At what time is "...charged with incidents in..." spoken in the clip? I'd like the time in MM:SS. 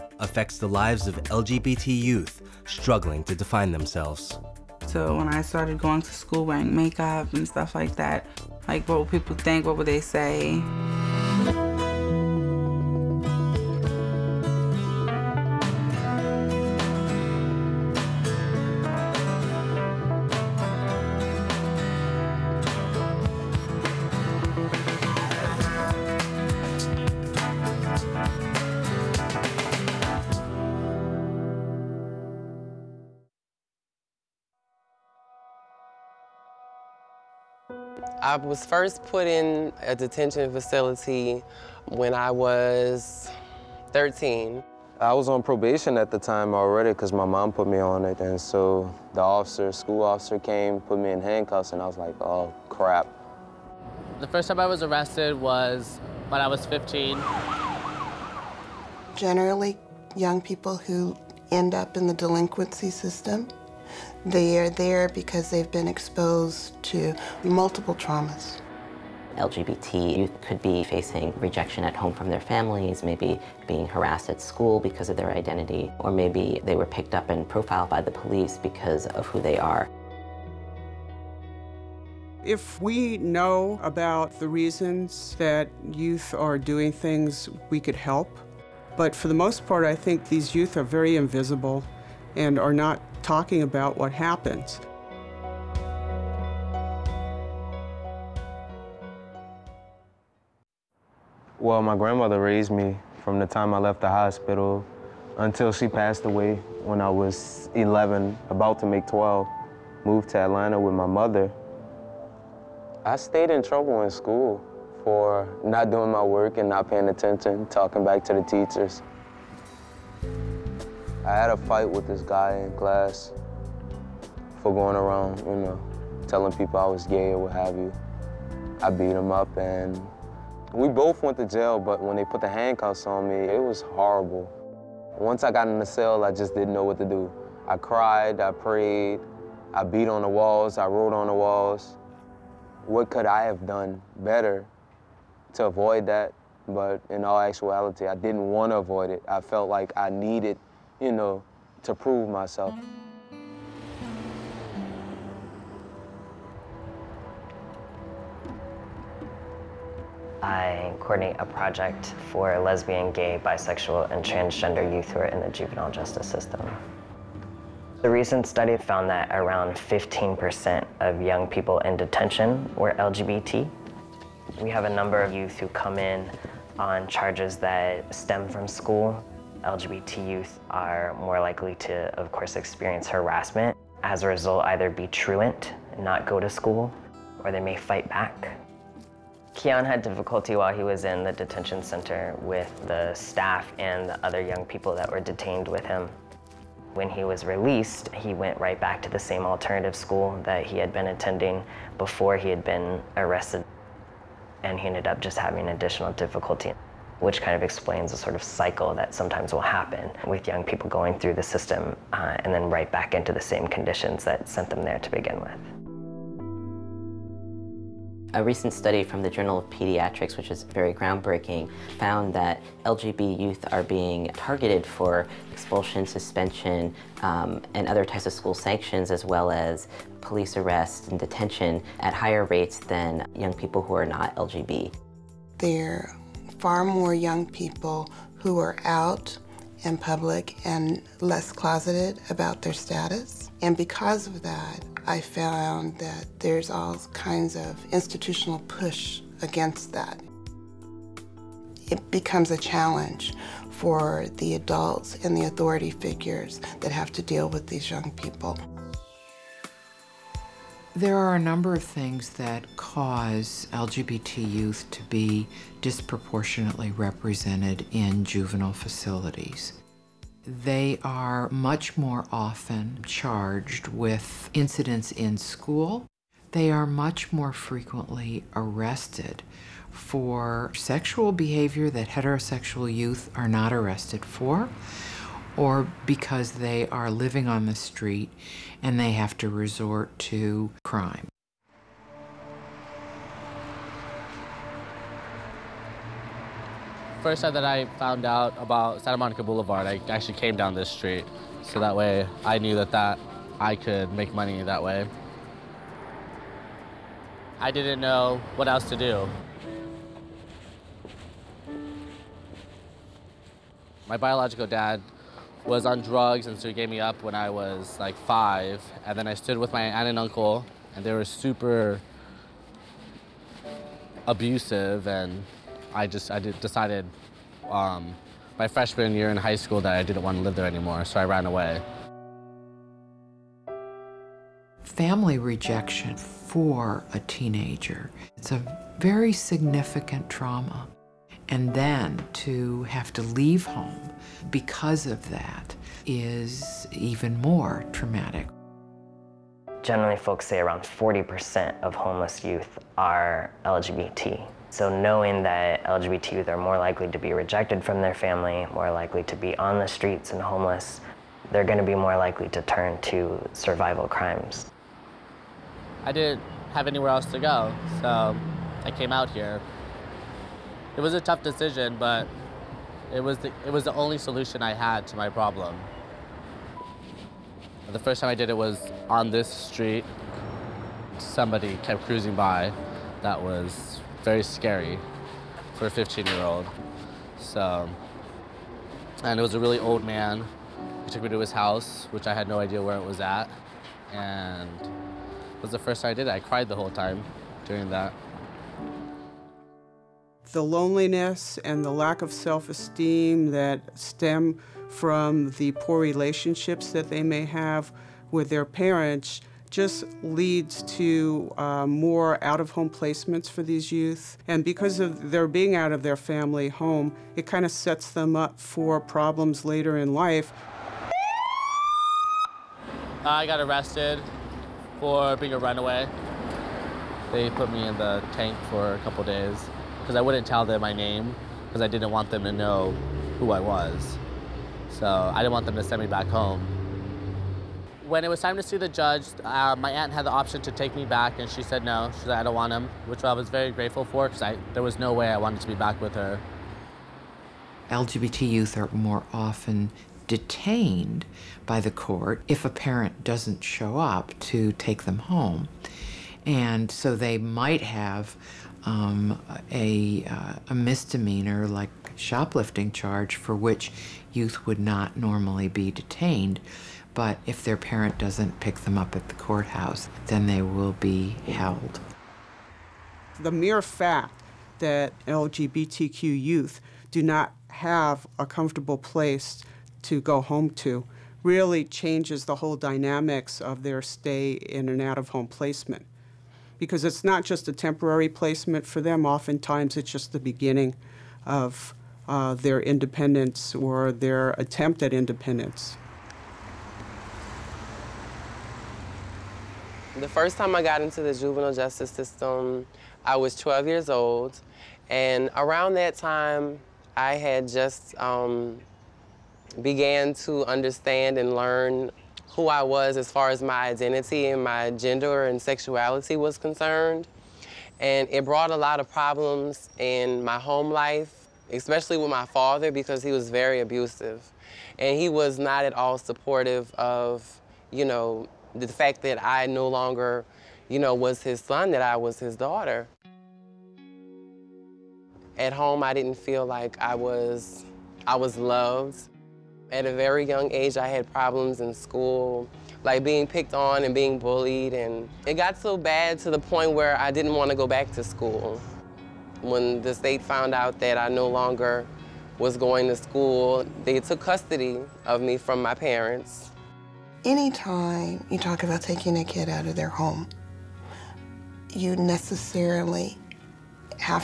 04:33.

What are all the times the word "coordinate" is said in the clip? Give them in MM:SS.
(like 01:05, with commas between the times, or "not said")
02:41.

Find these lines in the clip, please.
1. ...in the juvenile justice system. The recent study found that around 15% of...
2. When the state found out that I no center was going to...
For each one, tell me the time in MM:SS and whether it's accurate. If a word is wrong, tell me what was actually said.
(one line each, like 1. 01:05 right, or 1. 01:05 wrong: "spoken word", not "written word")
1. 02:45 right
2. 09:09 wrong: "longer", not "center".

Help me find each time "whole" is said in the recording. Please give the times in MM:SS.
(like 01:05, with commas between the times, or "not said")
06:36, 08:02.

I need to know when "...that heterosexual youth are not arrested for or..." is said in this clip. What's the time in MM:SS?
04:41.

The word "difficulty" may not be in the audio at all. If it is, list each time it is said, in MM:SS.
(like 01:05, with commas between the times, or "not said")
03:10, 03:26.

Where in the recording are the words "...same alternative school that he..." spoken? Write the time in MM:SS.
03:19.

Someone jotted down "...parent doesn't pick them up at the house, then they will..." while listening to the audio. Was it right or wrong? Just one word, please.
wrong.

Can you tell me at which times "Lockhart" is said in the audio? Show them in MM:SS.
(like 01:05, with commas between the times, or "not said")
not said.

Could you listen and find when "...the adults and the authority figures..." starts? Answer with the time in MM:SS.
04:14.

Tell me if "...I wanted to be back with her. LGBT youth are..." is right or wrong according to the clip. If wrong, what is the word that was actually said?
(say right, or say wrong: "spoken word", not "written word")
right.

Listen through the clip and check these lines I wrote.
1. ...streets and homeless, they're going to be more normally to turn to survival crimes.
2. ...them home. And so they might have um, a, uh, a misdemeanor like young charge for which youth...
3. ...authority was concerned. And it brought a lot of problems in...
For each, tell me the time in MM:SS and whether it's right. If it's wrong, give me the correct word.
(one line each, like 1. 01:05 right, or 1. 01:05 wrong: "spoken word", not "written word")
1. 05:59 wrong: "likely", not "normally"
2. 07:35 wrong: "shoplifting", not "young"
3. 08:35 wrong: "sexuality", not "authority".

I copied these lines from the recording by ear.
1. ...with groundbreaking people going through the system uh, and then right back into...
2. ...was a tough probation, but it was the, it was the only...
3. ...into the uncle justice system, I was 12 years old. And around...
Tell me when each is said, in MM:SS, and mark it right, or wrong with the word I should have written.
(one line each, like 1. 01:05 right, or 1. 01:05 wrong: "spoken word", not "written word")
1. 03:30 wrong: "young", not "groundbreaking"
2. 06:11 wrong: "decision", not "probation"
3. 08:21 wrong: "juvenile", not "uncle".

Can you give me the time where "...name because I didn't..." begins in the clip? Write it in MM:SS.
07:10.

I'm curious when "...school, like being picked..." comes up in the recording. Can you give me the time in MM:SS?
09:01.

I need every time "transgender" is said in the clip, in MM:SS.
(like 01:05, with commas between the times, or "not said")
02:44.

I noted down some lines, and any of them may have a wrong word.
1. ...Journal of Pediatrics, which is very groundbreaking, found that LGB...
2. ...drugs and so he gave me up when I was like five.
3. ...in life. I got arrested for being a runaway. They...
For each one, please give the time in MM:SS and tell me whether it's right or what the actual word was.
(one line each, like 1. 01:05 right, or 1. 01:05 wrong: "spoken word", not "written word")
1. 03:39 right
2. 05:16 right
3. 06:59 right.